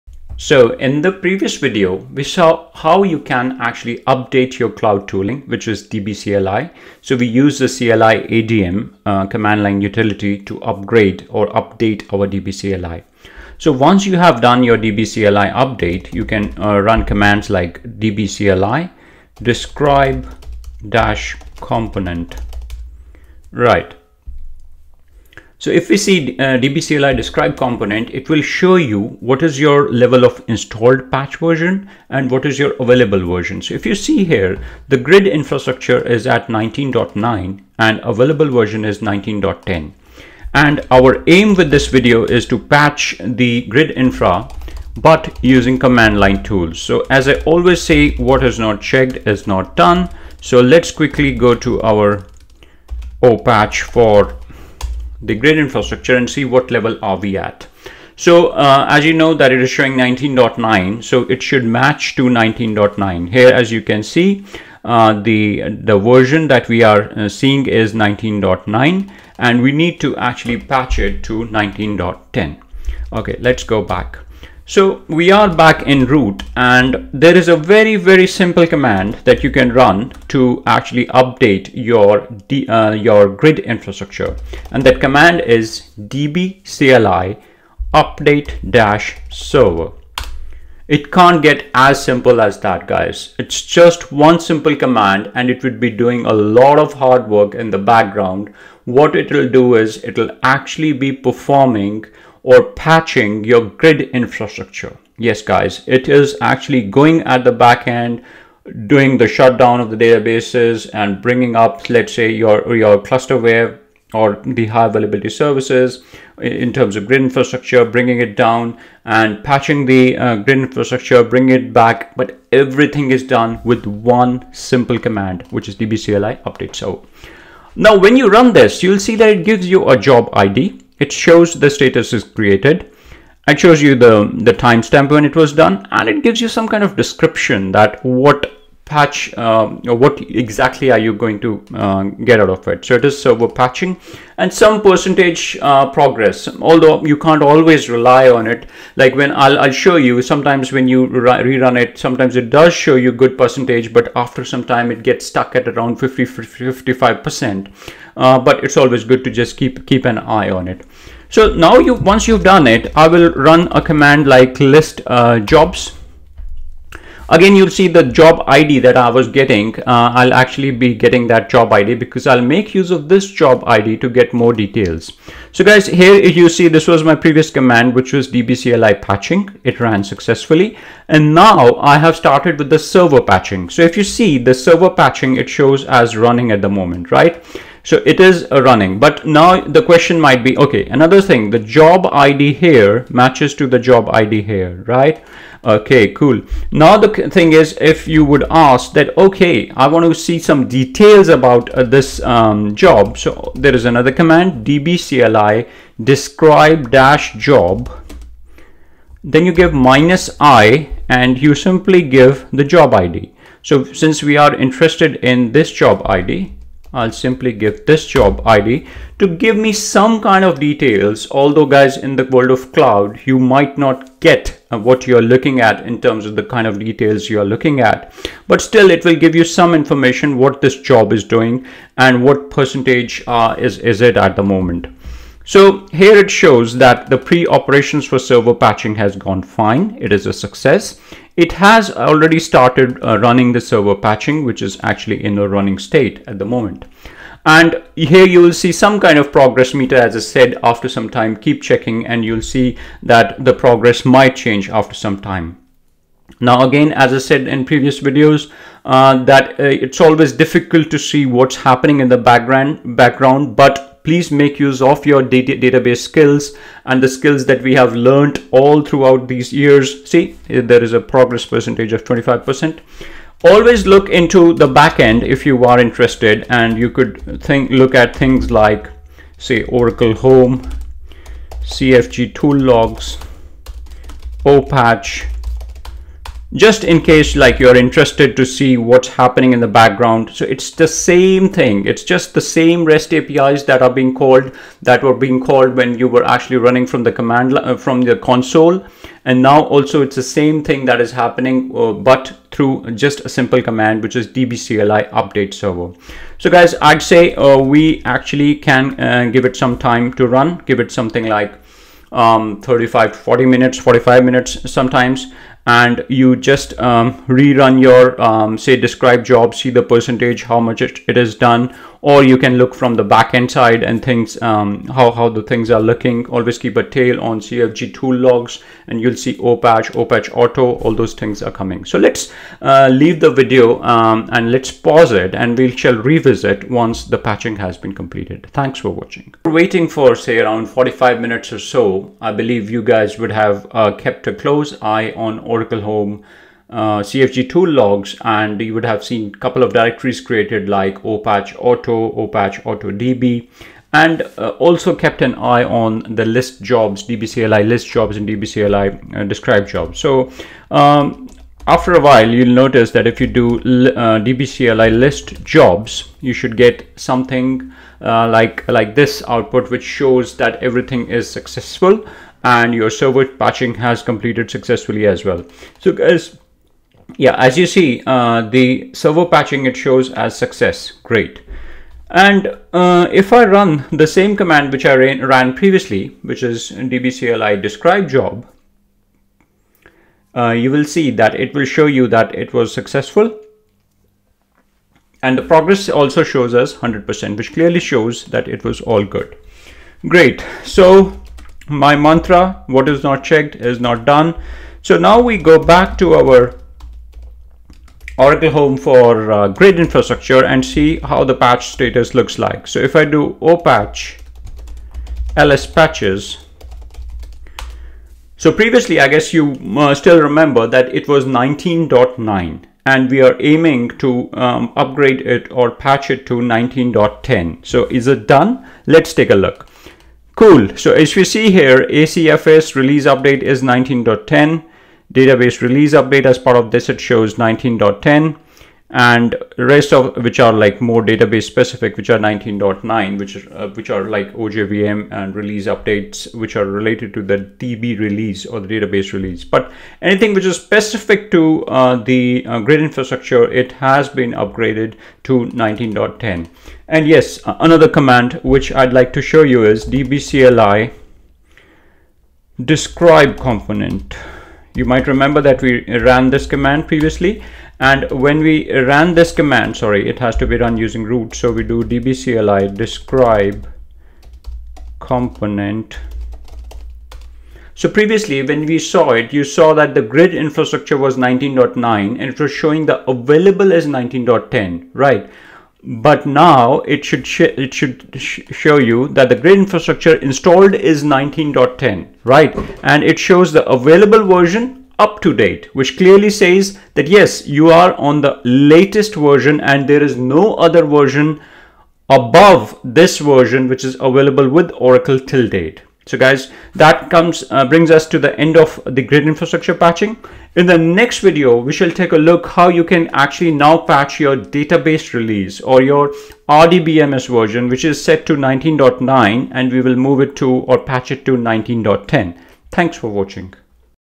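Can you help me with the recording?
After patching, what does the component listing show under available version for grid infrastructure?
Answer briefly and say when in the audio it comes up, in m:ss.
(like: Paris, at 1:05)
up to date, at 8:15.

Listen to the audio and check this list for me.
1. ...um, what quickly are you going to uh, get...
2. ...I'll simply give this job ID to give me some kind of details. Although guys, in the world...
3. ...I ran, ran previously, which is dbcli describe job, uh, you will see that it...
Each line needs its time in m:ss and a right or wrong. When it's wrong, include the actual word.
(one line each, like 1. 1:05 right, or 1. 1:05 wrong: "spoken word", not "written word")
1. 2:19 wrong: "exactly", not "quickly"
2. 3:36 right
3. 6:24 right.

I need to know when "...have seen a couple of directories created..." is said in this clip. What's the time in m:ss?
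5:48.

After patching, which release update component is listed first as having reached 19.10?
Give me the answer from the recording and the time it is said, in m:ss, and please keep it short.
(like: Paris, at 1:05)
ACFS release update, at 7:11.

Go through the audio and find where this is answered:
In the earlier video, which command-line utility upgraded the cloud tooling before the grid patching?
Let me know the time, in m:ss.
0:07.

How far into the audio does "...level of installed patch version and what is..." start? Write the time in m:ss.
0:29.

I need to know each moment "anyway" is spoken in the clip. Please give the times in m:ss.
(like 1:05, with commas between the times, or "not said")
not said.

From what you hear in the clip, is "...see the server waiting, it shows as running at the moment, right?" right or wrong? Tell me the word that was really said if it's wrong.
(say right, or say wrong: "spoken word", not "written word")
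wrong: "patching", not "waiting".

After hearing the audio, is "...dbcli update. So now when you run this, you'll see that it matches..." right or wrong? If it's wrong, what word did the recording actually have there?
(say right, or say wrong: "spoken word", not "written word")
wrong: "gives", not "matches".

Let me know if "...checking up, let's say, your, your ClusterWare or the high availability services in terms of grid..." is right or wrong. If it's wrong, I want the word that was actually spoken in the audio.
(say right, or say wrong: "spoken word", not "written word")
wrong: "bringing", not "checking".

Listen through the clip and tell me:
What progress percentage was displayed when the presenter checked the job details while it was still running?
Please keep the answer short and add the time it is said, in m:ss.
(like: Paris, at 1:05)
25%, at 4:32.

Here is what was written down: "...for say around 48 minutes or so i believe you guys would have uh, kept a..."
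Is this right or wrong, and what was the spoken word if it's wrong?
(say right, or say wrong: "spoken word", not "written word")
wrong: "45", not "48".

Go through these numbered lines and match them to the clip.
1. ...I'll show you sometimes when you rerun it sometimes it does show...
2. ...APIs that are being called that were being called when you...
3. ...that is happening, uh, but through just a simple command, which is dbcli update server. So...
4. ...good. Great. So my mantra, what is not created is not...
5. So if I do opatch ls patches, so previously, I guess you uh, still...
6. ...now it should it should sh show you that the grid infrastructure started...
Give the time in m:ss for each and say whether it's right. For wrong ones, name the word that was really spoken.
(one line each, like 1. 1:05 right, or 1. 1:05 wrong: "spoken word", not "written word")
1. 2:29 right
2. 4:53 right
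3. 5:00 right
4. 6:39 wrong: "checked", not "created"
5. 6:52 right
6. 8:06 wrong: "installed", not "started".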